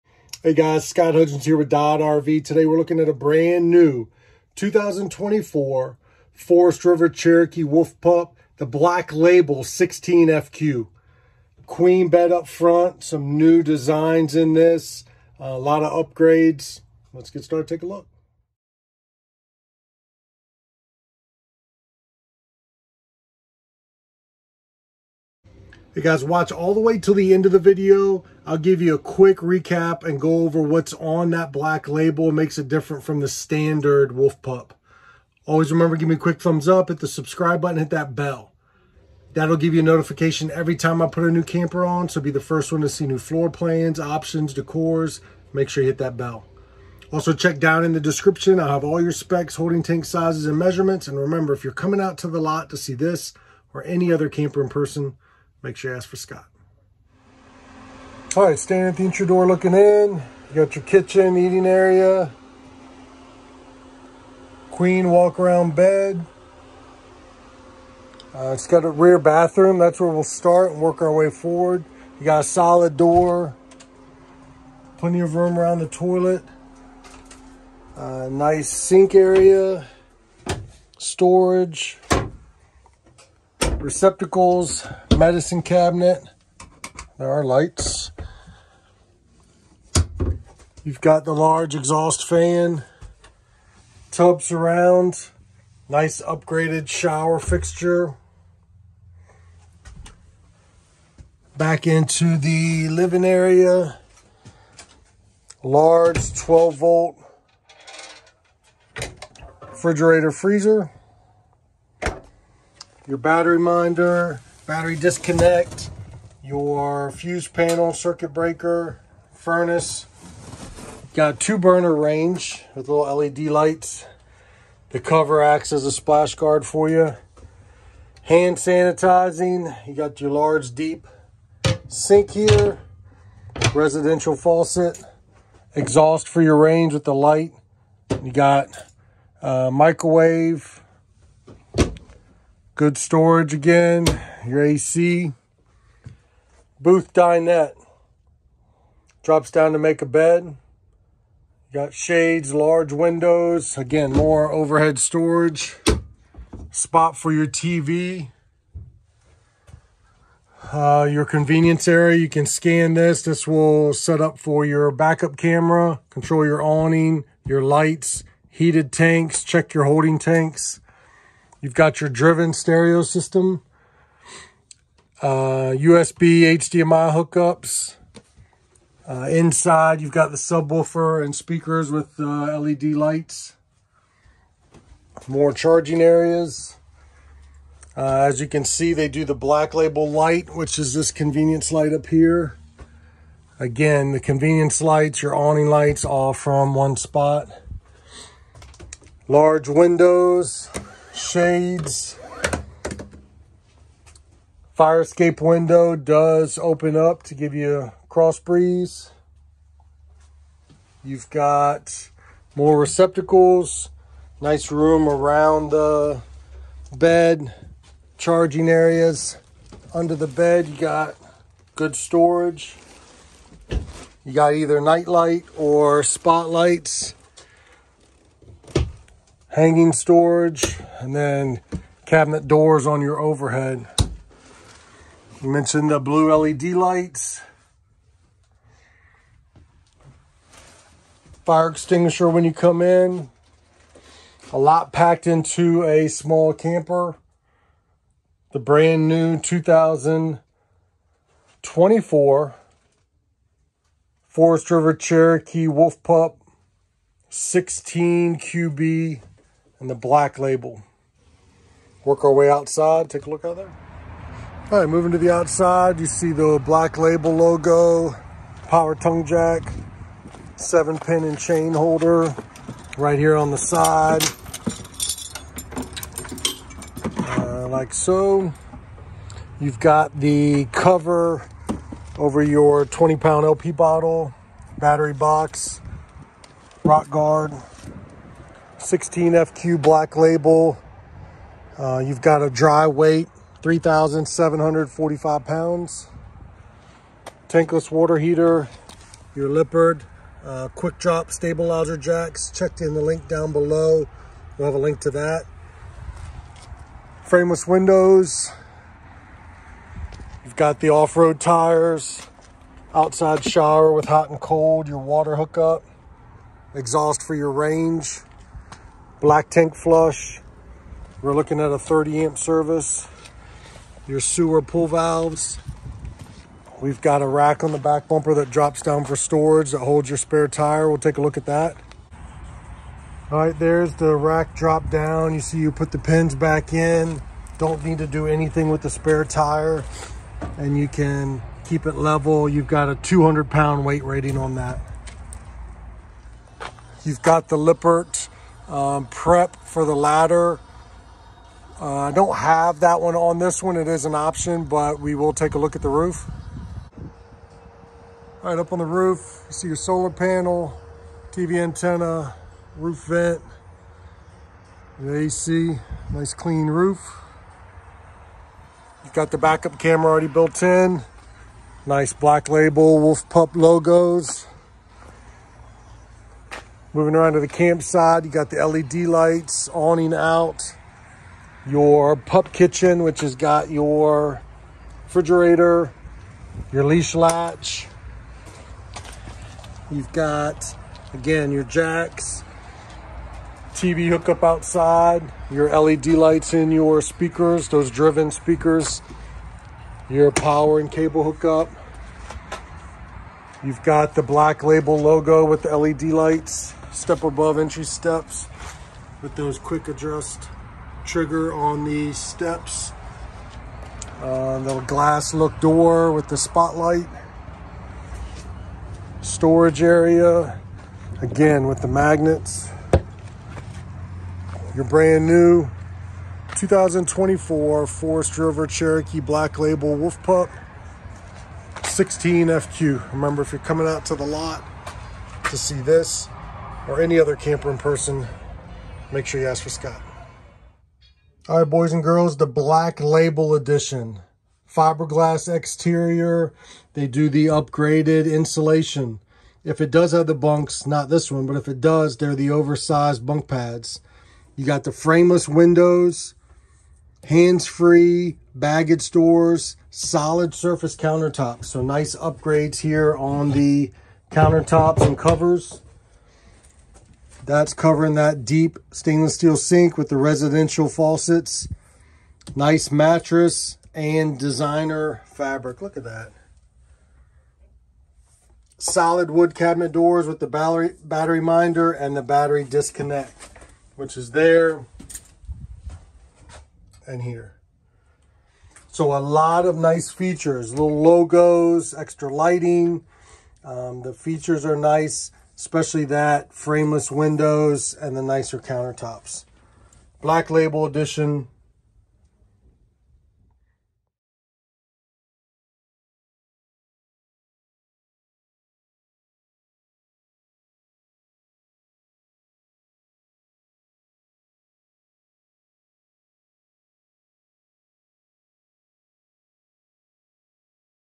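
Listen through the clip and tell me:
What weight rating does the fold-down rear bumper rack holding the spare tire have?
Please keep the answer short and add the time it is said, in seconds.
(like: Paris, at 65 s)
200 pounds, at 342 s.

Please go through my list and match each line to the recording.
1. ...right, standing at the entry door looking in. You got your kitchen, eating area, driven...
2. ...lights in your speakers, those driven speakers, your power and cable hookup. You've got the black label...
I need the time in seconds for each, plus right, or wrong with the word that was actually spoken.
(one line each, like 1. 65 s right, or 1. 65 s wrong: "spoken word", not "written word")
1. 58 s wrong: "queen", not "driven"
2. 396 s right.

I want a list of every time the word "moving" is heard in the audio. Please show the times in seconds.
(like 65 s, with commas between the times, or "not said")
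264 s, 376 s.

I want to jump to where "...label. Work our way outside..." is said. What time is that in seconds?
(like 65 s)
260 s.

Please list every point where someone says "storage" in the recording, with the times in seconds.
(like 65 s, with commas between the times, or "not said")
80 s, 142 s, 154 s, 221 s, 229 s, 329 s, 419 s.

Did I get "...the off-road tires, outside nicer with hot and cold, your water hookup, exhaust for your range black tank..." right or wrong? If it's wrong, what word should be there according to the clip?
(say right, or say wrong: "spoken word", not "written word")
wrong: "shower", not "nicer".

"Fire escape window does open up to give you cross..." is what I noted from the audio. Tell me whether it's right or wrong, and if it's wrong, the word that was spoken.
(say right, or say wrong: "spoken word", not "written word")
right.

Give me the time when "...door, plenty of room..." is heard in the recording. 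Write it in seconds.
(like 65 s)
72 s.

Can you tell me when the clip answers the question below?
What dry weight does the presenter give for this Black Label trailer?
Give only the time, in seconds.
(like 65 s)
293 s.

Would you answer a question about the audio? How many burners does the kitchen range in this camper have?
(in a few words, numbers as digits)
2.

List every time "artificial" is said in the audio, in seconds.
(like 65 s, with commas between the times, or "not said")
not said.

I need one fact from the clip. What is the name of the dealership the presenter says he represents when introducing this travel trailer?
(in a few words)
Dodd RV.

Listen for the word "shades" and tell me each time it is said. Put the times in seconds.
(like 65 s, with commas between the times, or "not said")
151 s, 201 s.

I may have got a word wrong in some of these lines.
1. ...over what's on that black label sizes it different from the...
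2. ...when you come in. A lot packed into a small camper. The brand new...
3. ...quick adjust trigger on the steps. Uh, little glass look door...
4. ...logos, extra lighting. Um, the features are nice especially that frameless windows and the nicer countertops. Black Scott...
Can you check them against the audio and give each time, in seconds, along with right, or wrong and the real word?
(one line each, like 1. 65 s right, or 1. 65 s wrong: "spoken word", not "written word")
1. 30 s wrong: "makes", not "sizes"
2. 242 s right
3. 409 s right
4. 491 s wrong: "Label", not "Scott".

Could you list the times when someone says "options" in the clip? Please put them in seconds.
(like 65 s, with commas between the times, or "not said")
43 s, 354 s.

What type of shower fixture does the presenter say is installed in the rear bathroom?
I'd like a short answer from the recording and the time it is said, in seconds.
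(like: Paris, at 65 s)
upgraded shower fixture, at 96 s.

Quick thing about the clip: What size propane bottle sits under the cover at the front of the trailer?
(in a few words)
20 pound.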